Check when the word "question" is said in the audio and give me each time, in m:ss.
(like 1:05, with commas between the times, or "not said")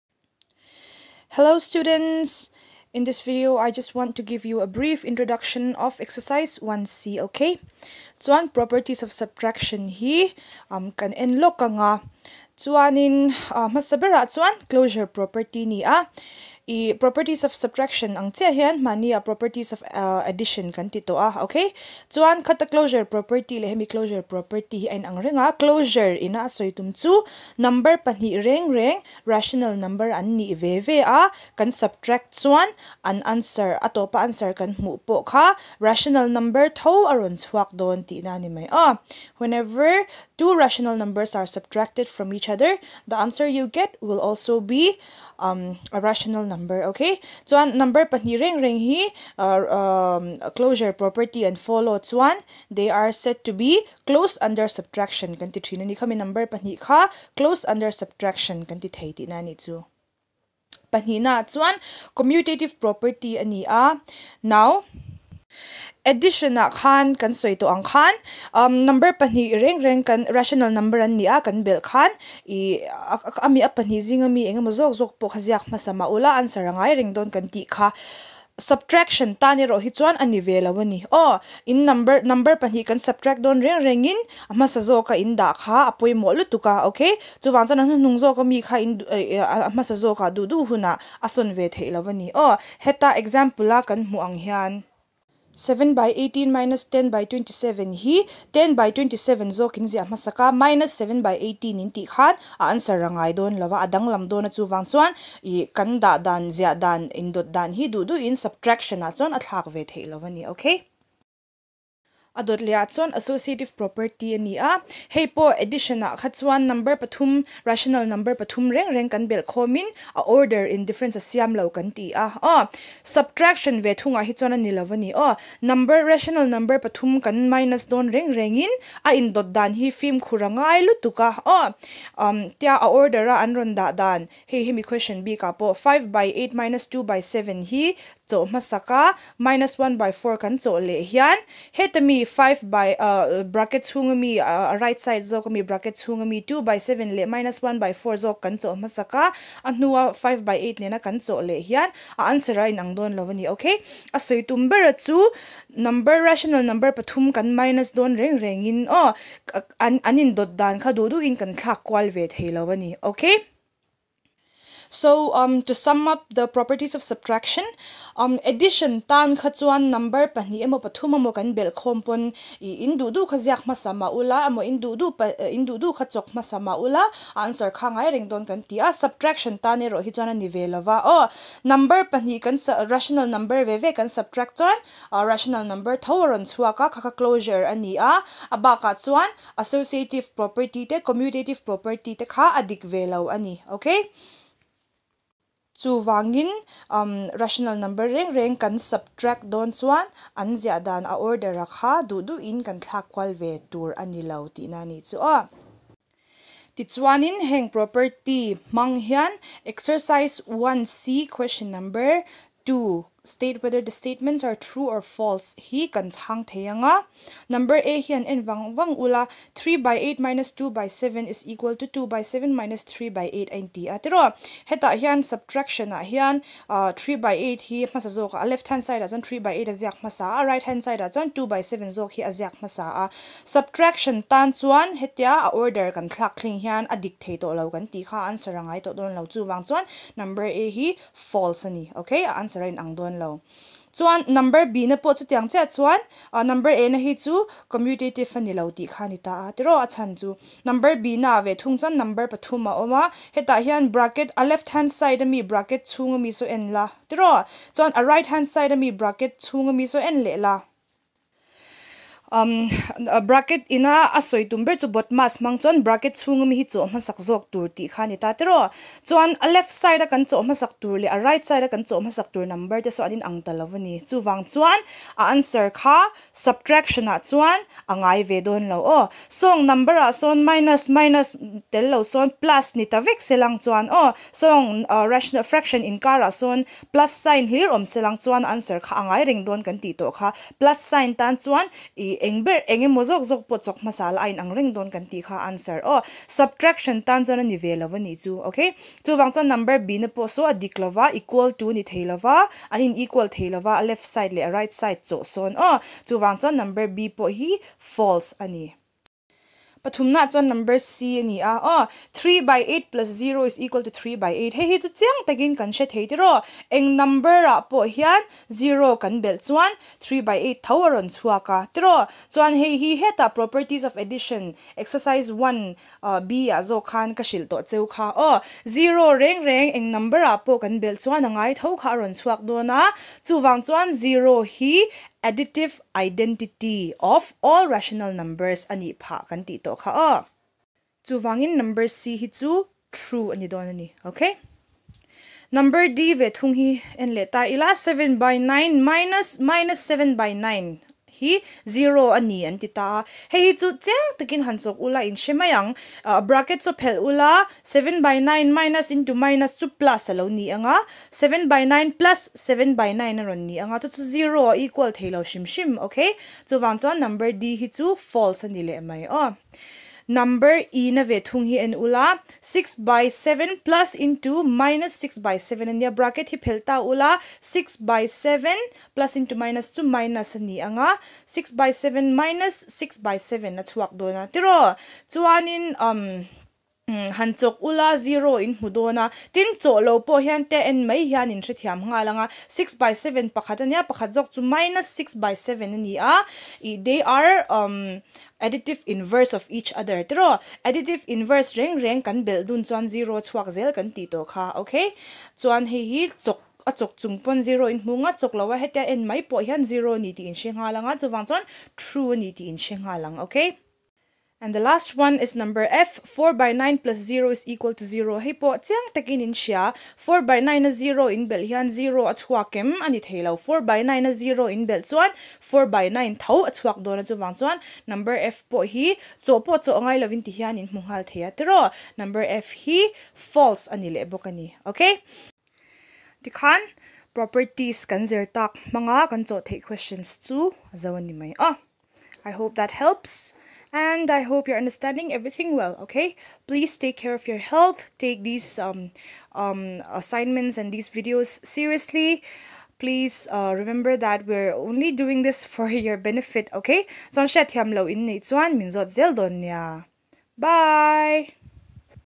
2:14, 3:31, 7:19.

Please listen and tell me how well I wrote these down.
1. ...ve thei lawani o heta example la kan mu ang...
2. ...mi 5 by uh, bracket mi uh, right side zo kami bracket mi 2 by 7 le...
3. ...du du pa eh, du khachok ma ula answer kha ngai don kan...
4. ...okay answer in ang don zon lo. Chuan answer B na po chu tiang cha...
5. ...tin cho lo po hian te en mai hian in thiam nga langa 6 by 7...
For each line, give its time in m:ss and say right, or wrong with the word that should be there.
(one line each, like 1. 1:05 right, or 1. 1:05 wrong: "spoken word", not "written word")
1. 1:31 right
2. 2:22 right
3. 2:54 right
4. 4:02 wrong: "number", not "answer"
5. 6:29 right.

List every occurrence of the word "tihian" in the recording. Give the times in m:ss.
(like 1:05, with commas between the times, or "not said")
7:10.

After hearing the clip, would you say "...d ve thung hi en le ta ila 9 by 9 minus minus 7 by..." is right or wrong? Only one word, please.
wrong.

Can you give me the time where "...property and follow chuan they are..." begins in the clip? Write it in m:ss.
0:50.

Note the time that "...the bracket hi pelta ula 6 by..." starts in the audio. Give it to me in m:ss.
6:15.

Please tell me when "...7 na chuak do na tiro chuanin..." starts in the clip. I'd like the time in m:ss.
6:23.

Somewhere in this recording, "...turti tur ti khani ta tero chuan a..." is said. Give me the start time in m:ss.
4:27.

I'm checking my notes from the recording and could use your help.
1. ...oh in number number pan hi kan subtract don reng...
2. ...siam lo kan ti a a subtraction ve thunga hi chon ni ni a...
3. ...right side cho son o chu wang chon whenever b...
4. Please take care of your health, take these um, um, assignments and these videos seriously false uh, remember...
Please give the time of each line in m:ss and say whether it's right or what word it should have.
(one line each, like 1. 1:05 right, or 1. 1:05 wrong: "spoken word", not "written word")
1. 1:21 right
2. 2:01 right
3. 5:04 wrong: "number", not "whenever"
4. 7:26 wrong: "please", not "false".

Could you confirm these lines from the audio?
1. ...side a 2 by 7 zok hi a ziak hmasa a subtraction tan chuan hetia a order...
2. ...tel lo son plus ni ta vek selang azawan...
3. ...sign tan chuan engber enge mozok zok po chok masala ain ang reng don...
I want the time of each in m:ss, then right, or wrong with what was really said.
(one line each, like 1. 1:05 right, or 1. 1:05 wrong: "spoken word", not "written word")
1. 3:50 right
2. 4:41 wrong: "chuan", not "azawan"
3. 4:50 right.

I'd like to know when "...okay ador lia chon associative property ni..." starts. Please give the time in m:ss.
1:50.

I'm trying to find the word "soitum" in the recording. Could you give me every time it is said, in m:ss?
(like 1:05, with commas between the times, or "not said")
2:34.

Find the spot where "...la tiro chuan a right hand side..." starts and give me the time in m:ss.
4:16.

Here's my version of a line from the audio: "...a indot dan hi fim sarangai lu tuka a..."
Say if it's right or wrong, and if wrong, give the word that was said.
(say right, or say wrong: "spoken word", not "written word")
wrong: "khurangai", not "sarangai".